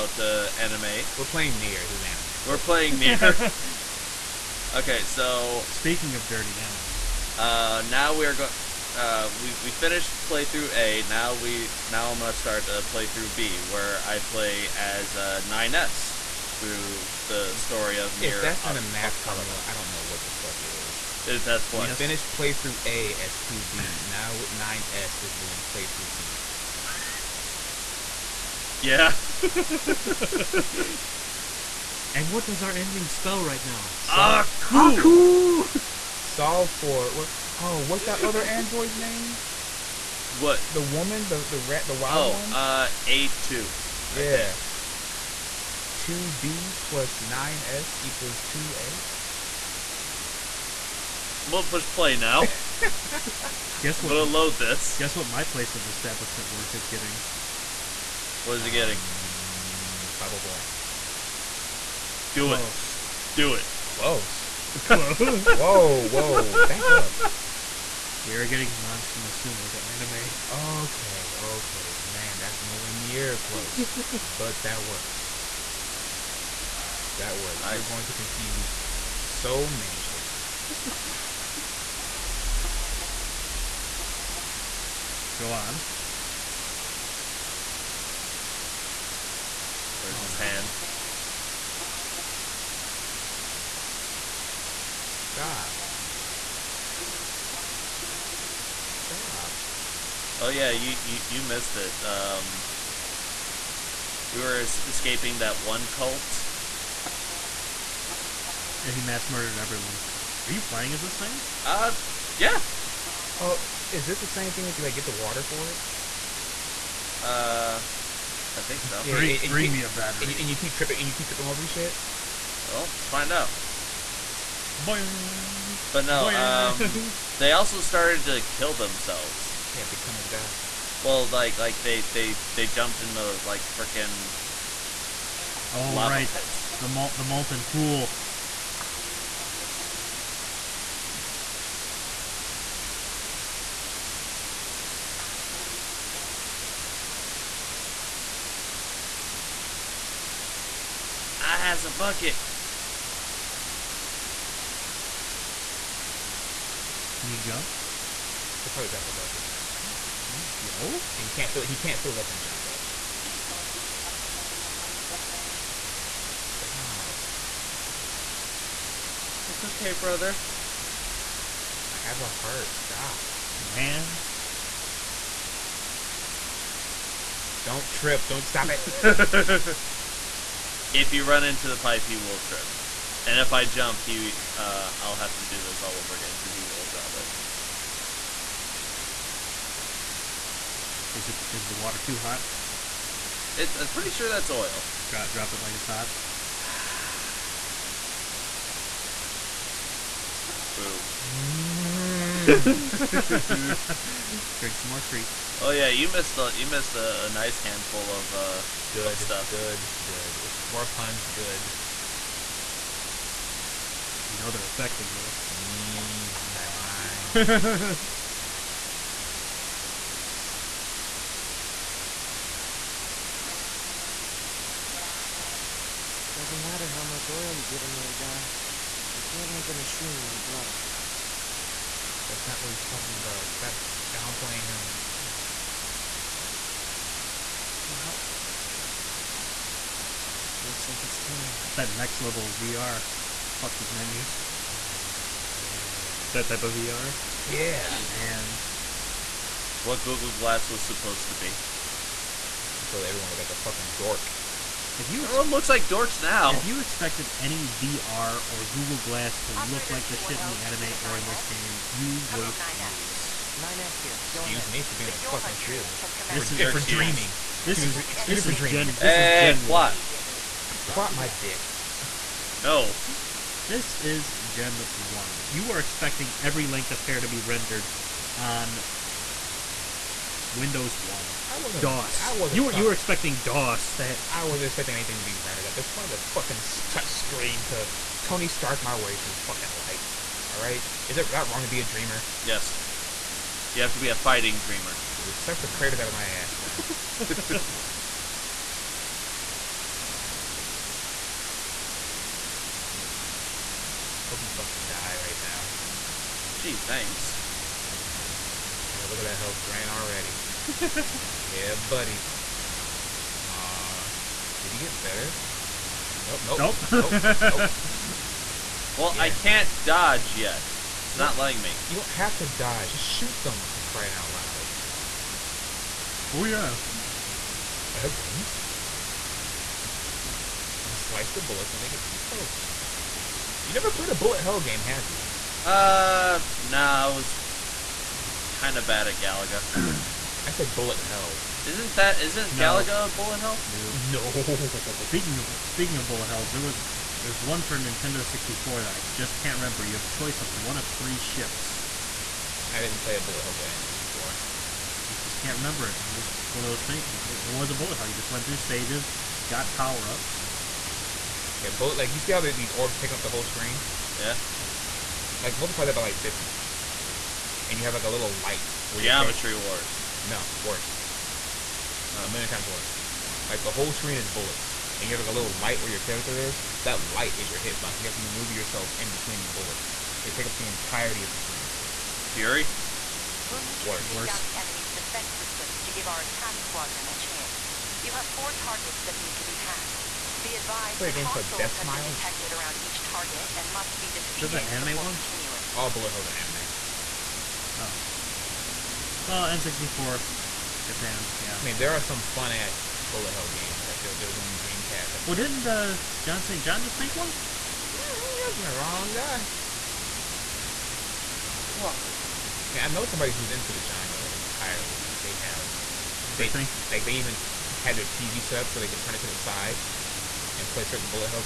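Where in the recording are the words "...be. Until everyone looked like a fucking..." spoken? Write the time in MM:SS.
04:11.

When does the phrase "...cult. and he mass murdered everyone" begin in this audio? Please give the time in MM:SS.
01:45.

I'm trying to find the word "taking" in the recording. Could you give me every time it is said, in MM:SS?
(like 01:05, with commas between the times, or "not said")
06:03.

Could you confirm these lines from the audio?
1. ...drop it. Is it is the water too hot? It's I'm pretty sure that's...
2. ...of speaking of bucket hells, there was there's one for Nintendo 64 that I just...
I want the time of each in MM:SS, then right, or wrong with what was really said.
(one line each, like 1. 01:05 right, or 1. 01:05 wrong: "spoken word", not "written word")
1. 03:06 right
2. 05:45 wrong: "bullet", not "bucket".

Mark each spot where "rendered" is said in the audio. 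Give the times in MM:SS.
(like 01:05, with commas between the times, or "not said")
04:37, 04:45.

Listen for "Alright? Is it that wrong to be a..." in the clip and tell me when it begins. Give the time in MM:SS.
04:50.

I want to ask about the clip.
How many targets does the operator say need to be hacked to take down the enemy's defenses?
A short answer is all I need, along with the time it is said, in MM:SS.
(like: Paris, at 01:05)
4, at 06:28.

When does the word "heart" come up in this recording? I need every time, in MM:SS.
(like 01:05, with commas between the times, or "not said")
02:52.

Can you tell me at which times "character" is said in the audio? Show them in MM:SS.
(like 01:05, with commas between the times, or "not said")
06:16.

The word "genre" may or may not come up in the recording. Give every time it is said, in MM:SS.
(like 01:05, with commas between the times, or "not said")
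06:53.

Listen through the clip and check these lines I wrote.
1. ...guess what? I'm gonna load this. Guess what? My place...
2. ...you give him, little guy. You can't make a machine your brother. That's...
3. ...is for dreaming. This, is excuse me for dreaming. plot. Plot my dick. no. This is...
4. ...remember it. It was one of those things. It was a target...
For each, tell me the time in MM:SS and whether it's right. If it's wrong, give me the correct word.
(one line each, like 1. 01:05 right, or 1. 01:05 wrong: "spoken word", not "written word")
1. 00:53 right
2. 03:47 right
3. 04:26 right
4. 05:55 wrong: "bullet", not "target".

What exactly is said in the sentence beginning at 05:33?
You never played a bullet hell game, have you?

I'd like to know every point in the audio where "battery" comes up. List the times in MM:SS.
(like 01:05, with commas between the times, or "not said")
01:59.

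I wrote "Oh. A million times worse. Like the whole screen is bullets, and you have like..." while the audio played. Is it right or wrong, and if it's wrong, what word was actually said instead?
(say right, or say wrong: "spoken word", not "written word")
right.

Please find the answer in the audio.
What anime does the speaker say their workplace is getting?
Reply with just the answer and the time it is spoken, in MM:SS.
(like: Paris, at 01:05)
Monster Musume, at 01:08.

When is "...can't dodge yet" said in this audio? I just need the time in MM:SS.
05:19.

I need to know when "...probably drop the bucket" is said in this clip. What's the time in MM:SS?
02:38.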